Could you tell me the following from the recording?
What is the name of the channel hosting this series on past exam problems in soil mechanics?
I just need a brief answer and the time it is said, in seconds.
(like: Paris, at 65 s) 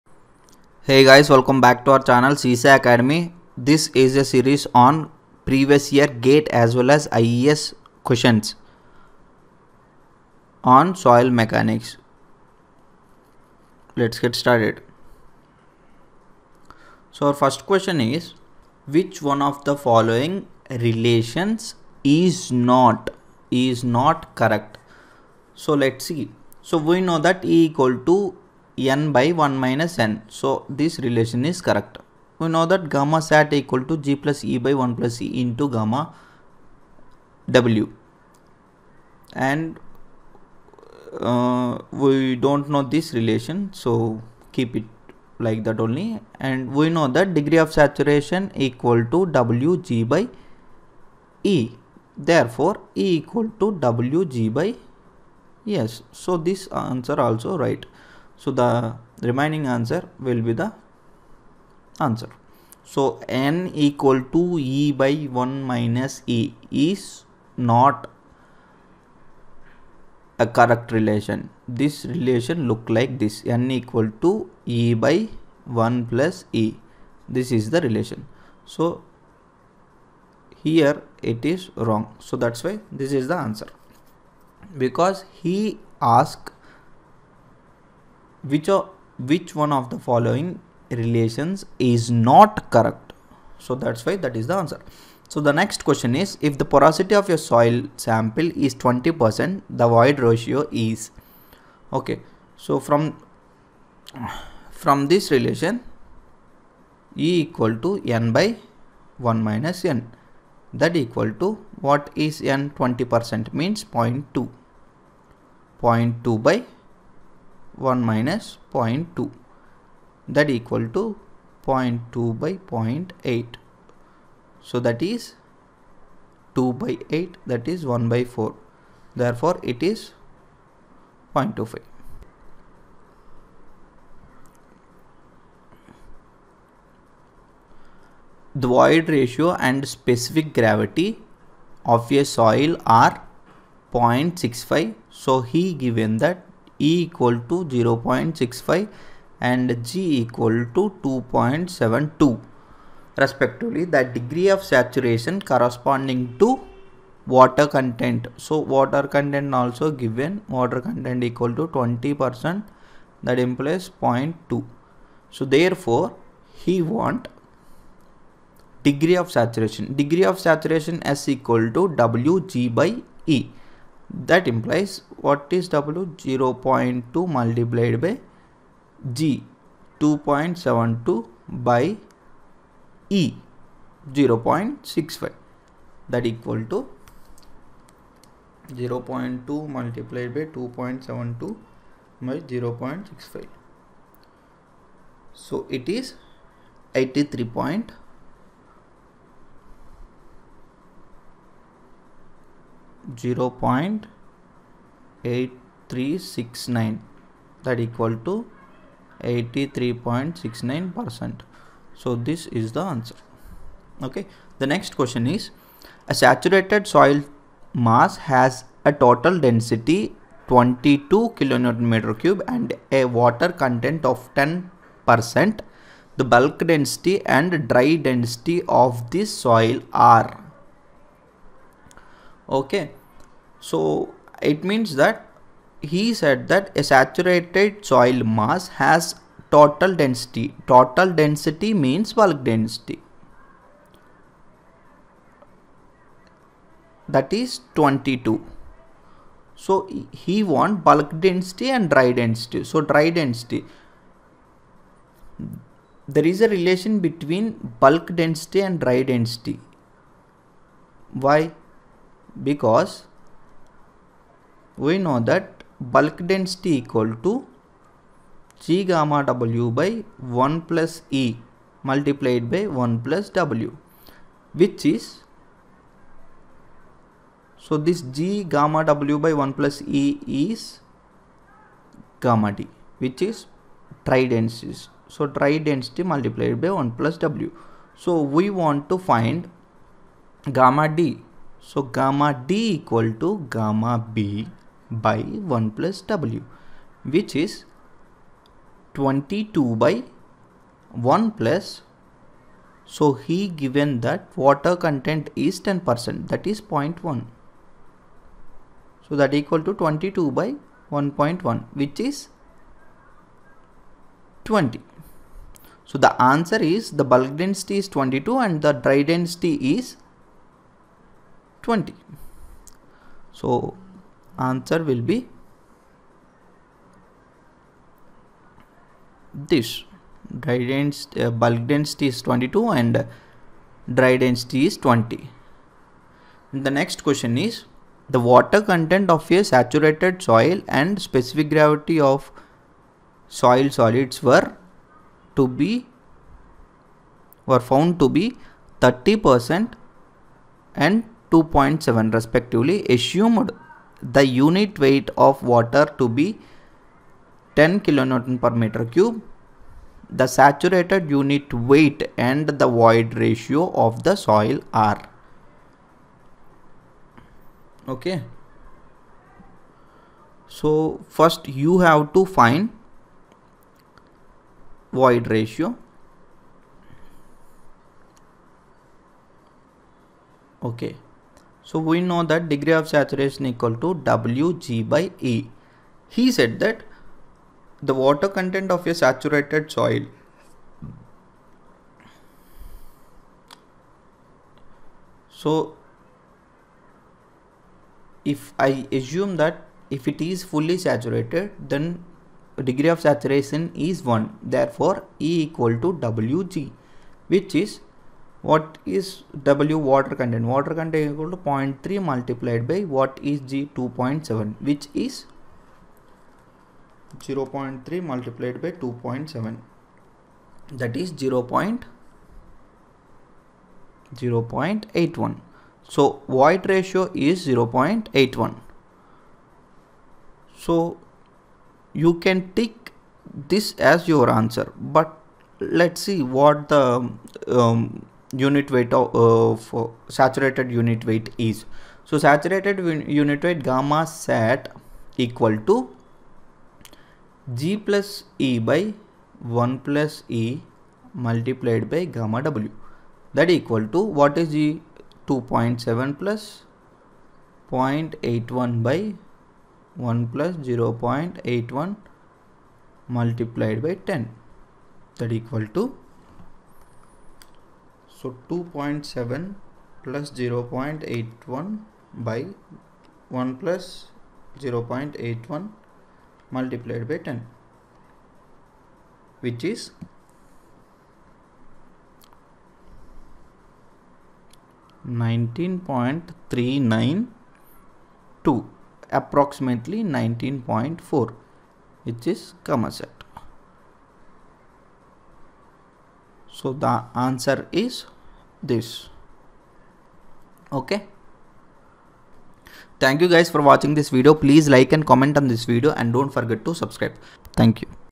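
Sesa Academy, at 2 s.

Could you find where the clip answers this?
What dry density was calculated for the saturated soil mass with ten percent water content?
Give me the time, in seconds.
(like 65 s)
311 s.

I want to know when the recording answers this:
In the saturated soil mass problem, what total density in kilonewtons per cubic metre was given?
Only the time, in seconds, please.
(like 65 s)
220 s.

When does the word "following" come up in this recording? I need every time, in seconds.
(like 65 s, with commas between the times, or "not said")
19 s, 89 s.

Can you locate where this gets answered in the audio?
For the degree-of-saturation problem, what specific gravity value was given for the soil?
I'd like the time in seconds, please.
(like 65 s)
151 s.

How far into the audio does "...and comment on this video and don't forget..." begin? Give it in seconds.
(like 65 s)
504 s.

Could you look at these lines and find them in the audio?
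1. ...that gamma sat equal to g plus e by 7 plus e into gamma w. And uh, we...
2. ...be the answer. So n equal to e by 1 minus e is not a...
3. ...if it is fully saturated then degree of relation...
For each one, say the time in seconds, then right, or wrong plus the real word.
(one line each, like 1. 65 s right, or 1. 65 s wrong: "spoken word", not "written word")
1. 32 s wrong: "1", not "7"
2. 60 s right
3. 399 s wrong: "saturation", not "relation".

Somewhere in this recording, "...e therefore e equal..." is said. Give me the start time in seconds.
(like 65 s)
51 s.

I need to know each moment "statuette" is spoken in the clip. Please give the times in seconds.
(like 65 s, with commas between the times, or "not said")
not said.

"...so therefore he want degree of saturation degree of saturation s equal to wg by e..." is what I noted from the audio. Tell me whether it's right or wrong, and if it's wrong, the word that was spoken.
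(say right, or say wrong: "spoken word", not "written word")
right.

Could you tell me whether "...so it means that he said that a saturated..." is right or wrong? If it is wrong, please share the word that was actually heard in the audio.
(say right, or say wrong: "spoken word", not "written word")
right.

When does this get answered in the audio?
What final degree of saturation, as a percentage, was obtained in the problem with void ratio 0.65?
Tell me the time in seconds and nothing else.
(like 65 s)
209 s.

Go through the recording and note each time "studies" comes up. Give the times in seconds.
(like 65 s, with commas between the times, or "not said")
not said.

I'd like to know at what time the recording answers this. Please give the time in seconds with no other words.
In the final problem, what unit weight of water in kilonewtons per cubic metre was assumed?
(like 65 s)
357 s.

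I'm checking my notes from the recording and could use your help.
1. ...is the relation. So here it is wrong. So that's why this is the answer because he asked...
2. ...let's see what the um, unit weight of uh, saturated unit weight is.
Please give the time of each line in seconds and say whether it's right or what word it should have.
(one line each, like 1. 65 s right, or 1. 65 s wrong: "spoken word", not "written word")
1. 77 s right
2. 435 s right.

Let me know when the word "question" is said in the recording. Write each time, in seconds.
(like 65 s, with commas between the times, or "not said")
8 s, 17 s, 95 s, 214 s, 337 s.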